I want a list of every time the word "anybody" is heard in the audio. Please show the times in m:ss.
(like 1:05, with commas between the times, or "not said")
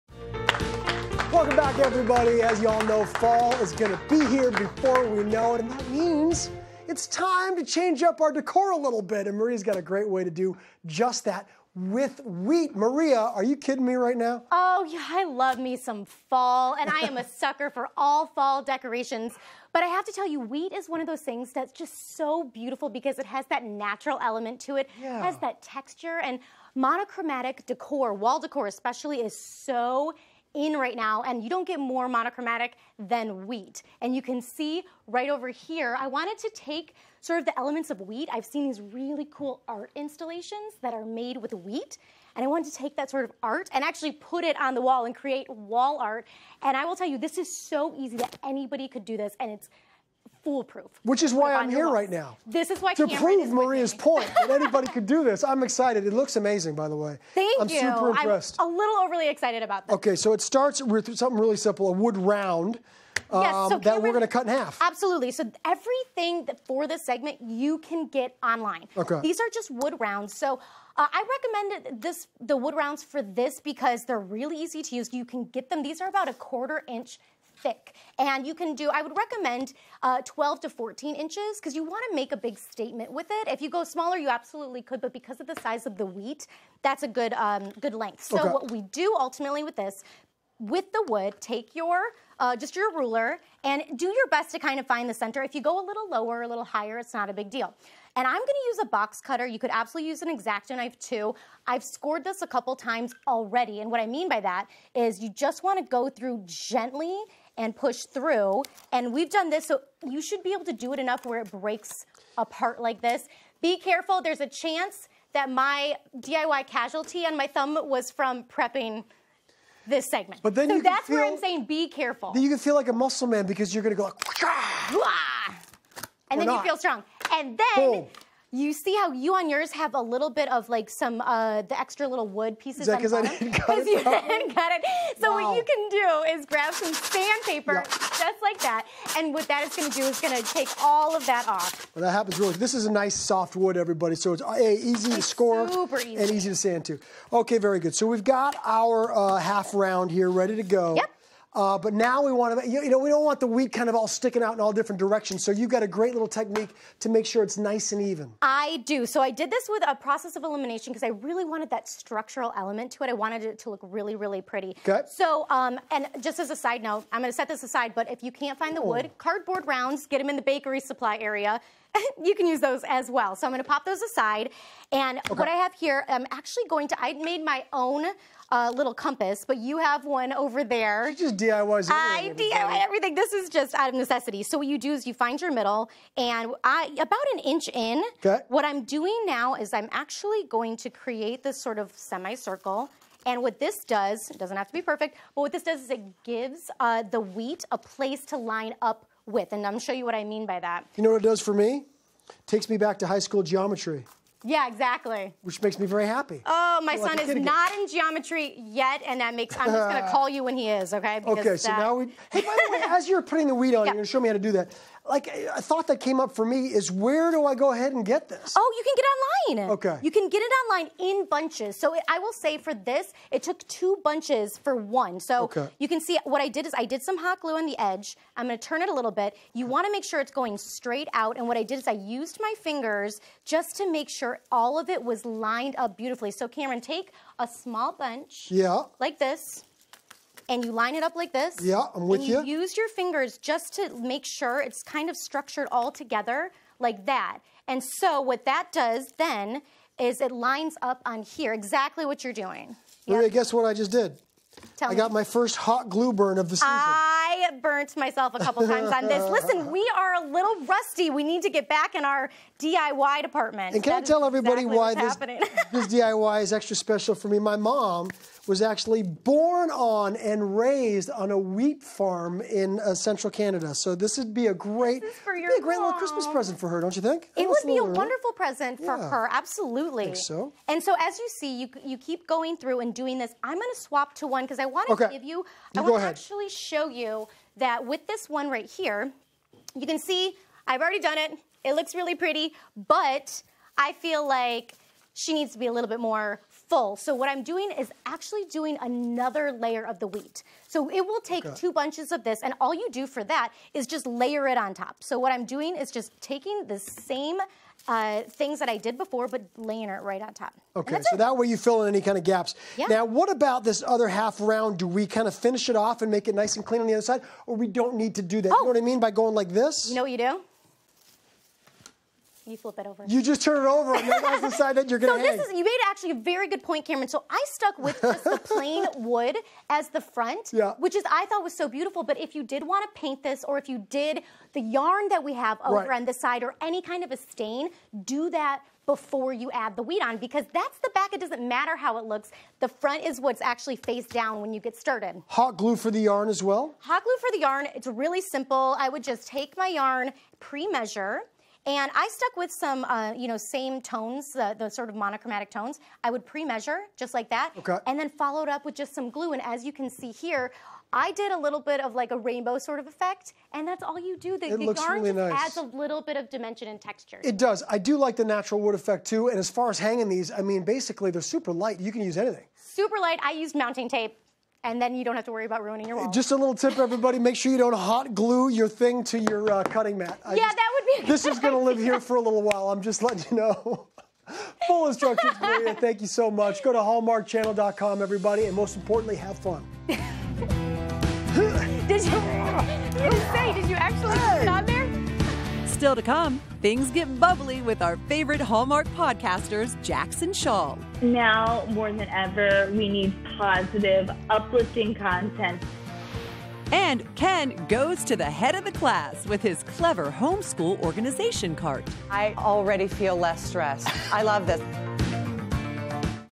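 0:48, 0:54.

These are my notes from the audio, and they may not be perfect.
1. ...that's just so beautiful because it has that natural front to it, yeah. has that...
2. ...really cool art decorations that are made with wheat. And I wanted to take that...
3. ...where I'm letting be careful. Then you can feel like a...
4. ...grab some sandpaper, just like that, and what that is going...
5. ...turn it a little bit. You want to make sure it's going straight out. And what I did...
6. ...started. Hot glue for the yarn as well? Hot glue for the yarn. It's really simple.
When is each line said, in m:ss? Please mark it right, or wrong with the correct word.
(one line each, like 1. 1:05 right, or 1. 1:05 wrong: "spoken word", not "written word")
1. 0:21 wrong: "element", not "front"
2. 0:38 wrong: "installations", not "decorations"
3. 2:01 wrong: "saying", not "letting"
4. 2:16 right
5. 3:48 right
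6. 5:44 right.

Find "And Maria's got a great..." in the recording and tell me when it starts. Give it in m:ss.
0:09.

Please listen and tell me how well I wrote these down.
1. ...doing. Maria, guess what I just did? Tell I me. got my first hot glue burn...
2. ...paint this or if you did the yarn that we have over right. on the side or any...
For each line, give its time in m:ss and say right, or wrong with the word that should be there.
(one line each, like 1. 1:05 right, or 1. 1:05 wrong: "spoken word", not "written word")
1. 4:12 right
2. 5:33 right.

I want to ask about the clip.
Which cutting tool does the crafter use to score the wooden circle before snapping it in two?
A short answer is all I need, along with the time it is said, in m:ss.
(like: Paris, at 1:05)
box cutter, at 1:38.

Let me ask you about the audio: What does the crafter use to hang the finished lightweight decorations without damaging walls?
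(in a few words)
mounting tape.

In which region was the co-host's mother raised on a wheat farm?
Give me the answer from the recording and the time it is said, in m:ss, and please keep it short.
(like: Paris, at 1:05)
central Canada, at 4:32.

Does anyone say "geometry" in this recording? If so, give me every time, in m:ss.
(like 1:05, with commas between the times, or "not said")
3:23, 3:27.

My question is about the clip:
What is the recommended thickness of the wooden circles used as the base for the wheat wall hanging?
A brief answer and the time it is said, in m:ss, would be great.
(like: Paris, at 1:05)
a quarter inch, at 1:16.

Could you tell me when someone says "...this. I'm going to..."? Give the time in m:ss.
4:43.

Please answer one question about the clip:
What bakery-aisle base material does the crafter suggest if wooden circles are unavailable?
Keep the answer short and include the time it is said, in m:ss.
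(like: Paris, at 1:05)
cardboard rounds, at 2:49.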